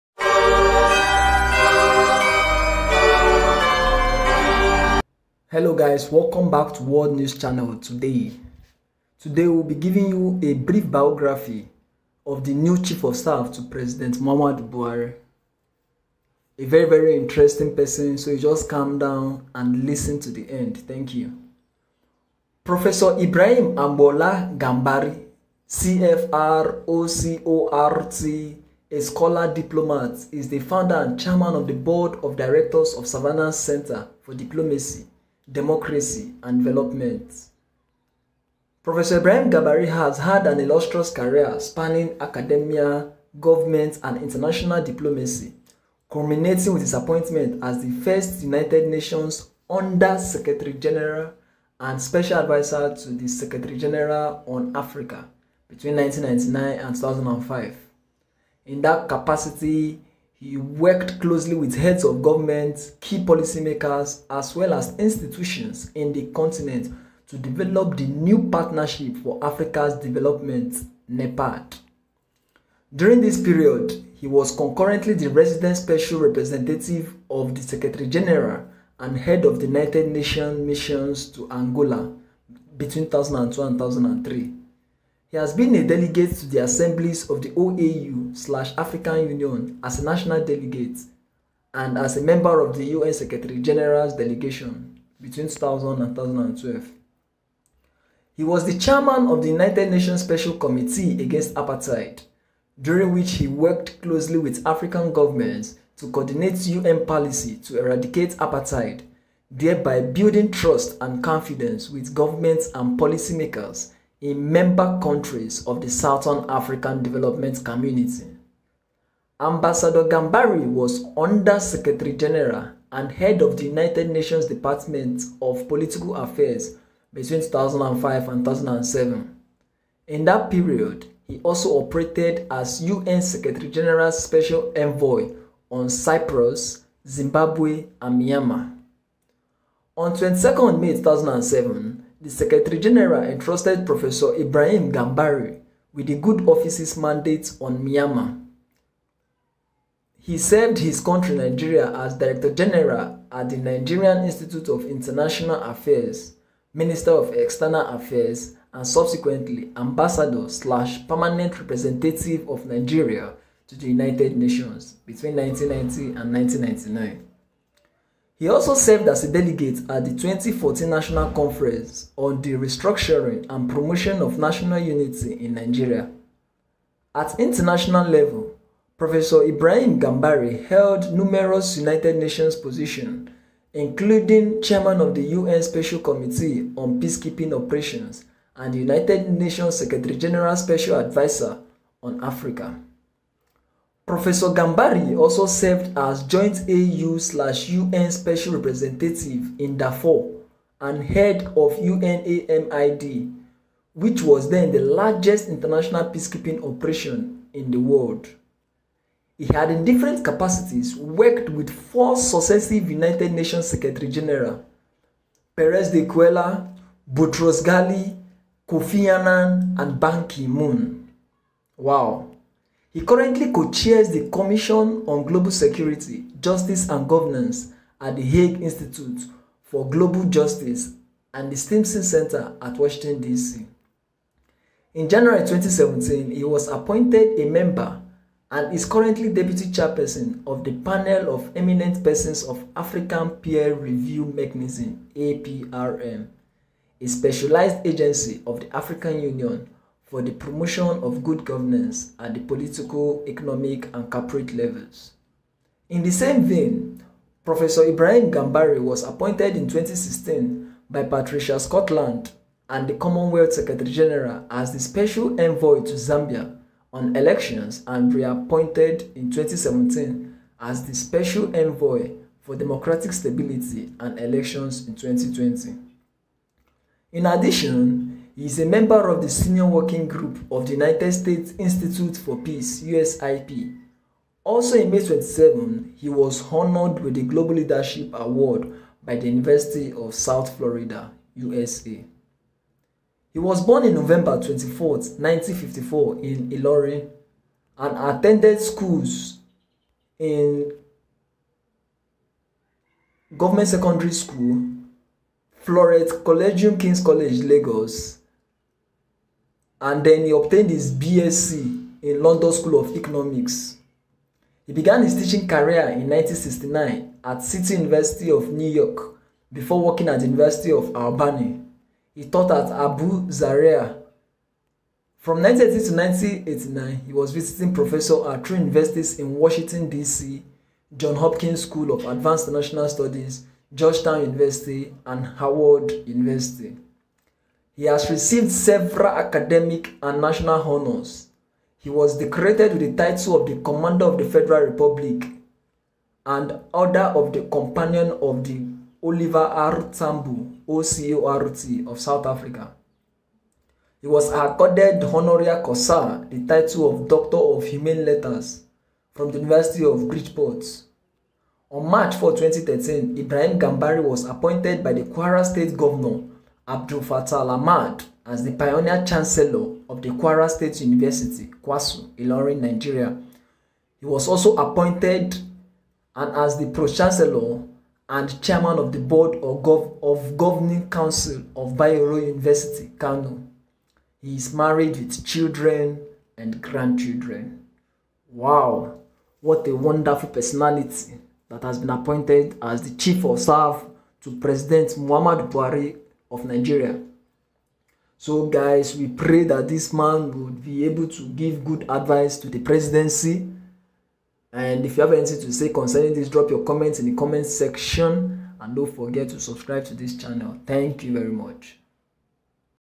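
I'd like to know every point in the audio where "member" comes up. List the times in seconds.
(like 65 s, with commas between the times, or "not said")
92 s, 114 s, 237 s, 278 s.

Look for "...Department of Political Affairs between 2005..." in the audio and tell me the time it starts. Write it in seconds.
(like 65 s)
124 s.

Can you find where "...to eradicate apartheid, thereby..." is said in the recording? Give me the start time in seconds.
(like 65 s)
107 s.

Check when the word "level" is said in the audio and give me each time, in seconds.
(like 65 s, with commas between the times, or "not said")
178 s, 254 s.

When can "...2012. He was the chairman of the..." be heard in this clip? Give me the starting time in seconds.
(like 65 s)
96 s.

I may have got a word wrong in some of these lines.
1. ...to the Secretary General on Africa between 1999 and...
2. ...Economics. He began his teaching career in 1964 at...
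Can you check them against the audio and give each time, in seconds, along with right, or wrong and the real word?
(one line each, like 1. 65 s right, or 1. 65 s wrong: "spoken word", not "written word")
1. 52 s right
2. 312 s wrong: "1969", not "1964".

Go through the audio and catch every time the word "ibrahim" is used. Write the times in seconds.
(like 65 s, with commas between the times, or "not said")
23 s, 39 s, 144 s, 179 s, 257 s, 363 s.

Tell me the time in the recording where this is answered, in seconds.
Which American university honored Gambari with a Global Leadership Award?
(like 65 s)
289 s.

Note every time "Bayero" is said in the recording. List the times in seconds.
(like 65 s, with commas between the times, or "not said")
381 s.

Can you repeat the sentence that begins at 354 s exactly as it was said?
He was accorded honoria causa, the title of Doctor of Humane Letters, from the University of Bridgeport.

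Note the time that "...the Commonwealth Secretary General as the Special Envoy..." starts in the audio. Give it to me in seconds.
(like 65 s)
262 s.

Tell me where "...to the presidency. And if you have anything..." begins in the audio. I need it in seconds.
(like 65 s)
402 s.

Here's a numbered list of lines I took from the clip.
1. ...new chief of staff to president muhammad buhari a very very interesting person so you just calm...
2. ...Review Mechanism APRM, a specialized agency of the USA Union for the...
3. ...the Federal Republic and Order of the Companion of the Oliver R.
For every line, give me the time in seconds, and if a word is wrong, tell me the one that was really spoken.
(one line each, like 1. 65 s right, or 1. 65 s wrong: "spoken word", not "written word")
1. 12 s right
2. 243 s wrong: "African", not "USA"
3. 344 s right.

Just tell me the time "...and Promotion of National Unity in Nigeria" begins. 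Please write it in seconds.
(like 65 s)
173 s.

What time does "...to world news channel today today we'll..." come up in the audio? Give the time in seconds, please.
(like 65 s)
6 s.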